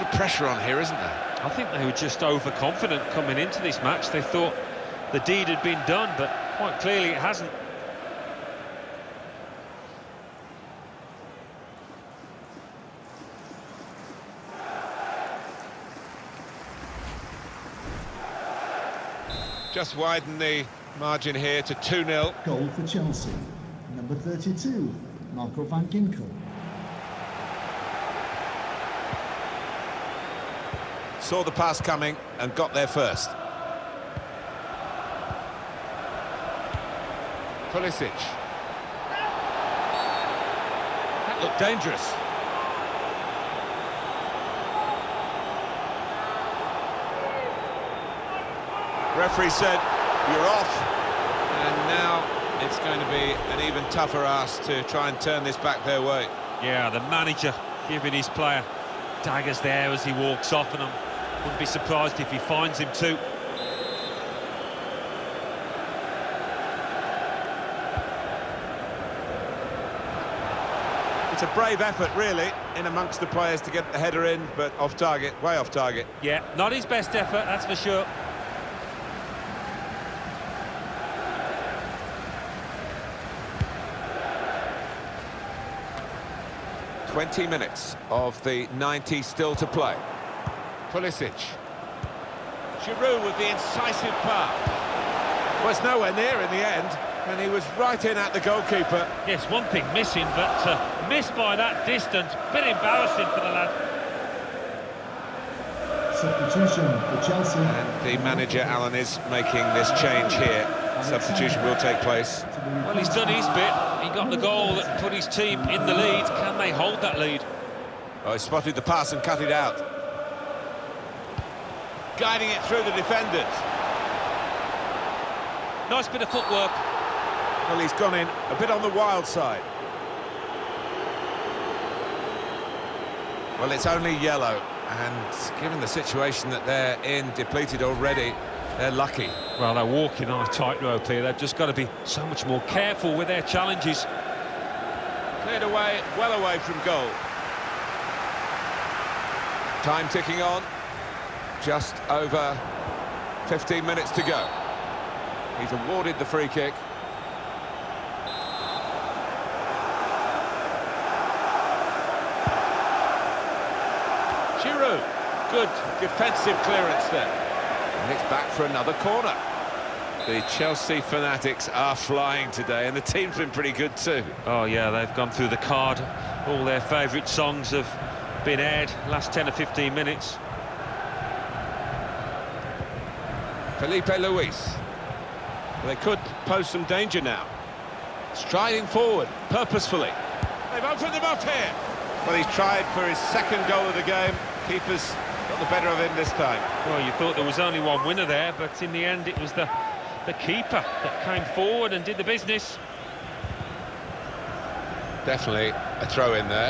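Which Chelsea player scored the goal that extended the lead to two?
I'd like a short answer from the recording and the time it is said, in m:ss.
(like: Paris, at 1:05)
Marco van Ginkel, at 0:25.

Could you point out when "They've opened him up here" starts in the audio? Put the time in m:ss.
3:10.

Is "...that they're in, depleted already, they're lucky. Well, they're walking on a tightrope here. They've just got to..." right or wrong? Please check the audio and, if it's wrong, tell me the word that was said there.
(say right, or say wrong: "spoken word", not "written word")
right.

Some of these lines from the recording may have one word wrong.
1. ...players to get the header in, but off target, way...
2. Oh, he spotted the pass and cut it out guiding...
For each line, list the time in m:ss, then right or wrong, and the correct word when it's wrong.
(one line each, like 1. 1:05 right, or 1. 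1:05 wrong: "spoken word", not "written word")
1. 1:13 right
2. 1:58 right.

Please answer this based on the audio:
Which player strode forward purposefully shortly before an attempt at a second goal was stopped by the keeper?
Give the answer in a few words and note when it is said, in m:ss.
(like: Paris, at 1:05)
Filipe Luís, at 3:03.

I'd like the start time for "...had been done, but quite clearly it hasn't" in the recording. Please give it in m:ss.
0:05.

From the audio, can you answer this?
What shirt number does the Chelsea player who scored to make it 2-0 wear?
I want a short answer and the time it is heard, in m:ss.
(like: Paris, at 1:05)
32, at 0:23.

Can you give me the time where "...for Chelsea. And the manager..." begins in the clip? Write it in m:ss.
1:46.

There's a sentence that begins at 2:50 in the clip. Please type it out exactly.
The Chelsea fanatics are flying today, and the team's been pretty good too.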